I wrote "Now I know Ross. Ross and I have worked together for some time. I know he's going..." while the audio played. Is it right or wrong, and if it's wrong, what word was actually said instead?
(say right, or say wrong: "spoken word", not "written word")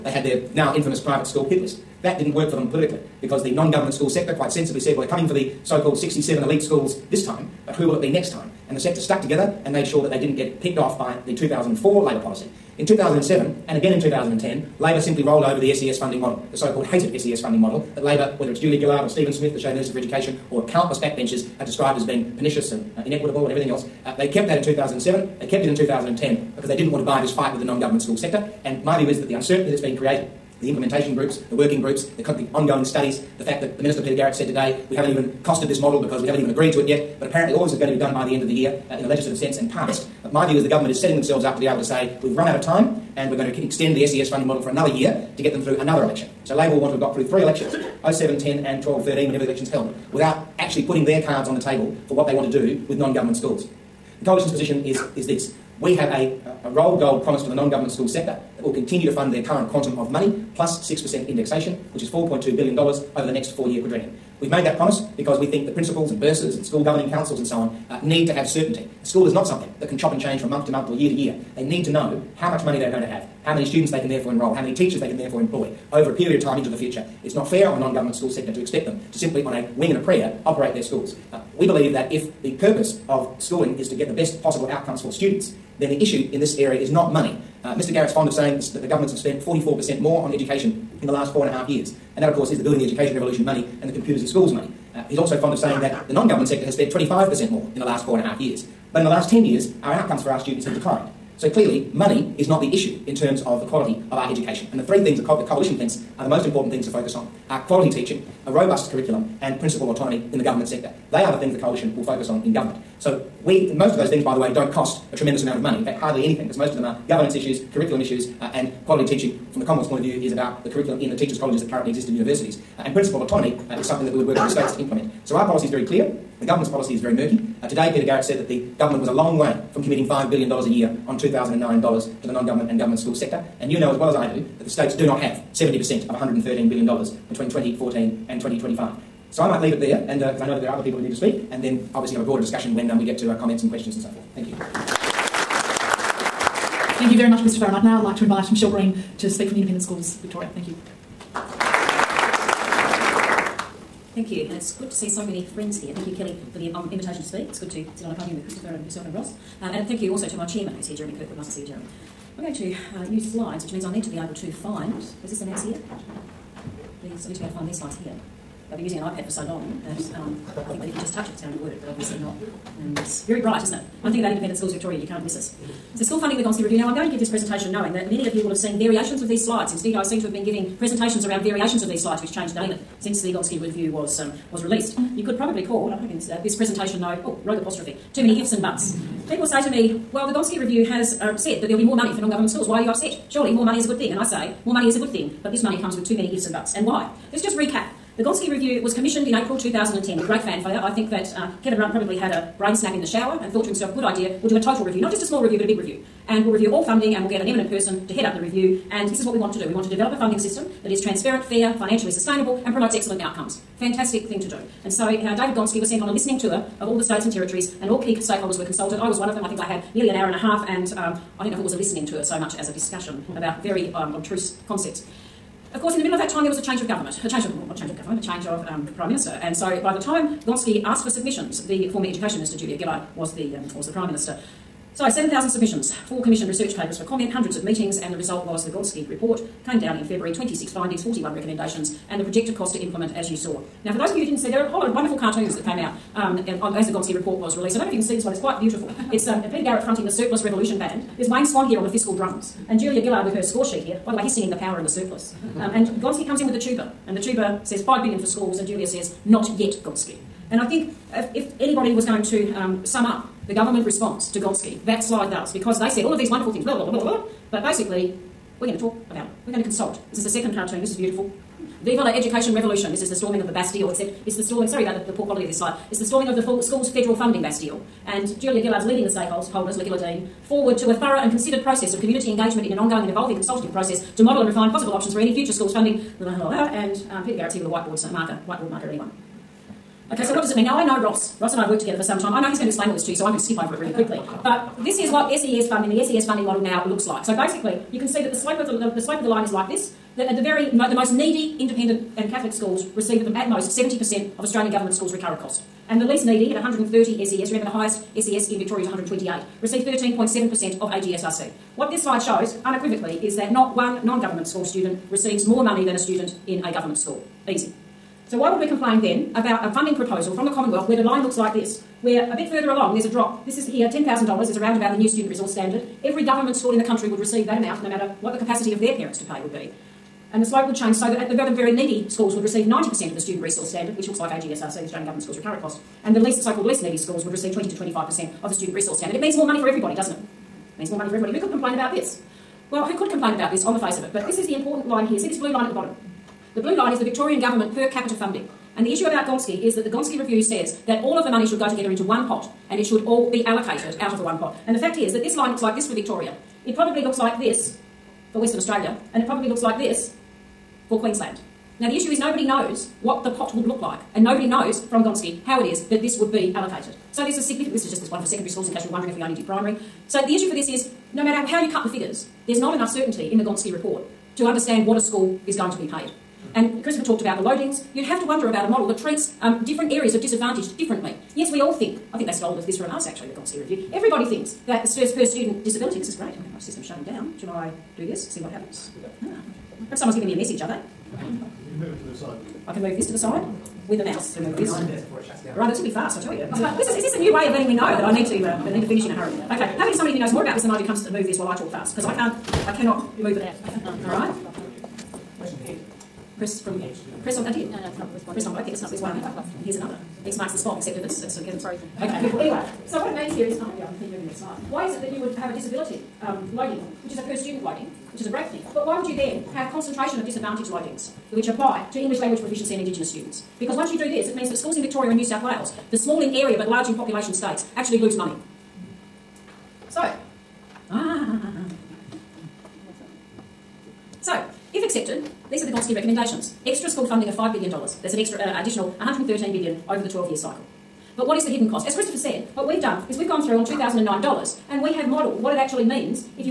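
right.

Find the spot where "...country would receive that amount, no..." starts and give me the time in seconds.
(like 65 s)
326 s.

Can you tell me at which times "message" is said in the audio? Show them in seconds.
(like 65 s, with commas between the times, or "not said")
390 s.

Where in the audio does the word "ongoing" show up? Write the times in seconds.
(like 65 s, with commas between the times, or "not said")
32 s, 282 s.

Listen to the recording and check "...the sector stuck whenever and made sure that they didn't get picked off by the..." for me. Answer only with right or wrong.
wrong.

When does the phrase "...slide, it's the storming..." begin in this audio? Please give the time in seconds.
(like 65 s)
275 s.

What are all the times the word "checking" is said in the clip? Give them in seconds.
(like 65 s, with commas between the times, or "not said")
not said.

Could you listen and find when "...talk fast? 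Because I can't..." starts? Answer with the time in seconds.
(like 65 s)
401 s.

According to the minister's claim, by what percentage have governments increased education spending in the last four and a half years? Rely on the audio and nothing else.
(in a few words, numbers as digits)
44%.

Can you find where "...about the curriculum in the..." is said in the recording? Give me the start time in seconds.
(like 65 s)
120 s.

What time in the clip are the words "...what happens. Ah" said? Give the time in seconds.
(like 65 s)
388 s.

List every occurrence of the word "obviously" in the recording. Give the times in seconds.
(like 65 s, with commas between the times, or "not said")
141 s, 171 s.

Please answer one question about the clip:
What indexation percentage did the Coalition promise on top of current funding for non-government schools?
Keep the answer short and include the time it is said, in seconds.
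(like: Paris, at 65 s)
6%, at 60 s.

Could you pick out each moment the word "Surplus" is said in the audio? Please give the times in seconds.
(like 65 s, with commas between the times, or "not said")
250 s, 254 s.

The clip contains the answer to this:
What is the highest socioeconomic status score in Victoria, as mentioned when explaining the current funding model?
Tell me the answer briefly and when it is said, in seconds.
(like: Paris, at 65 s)
128, at 308 s.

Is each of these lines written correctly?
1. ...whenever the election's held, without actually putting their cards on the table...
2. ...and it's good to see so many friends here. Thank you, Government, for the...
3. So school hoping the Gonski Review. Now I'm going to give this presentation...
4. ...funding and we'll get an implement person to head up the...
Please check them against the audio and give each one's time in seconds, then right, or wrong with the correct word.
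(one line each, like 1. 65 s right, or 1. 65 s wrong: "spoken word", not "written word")
1. 49 s right
2. 154 s wrong: "Kelly", not "Government"
3. 175 s wrong: "funding", not "hoping"
4. 206 s wrong: "eminent", not "implement".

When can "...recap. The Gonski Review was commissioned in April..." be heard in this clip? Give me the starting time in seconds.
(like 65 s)
197 s.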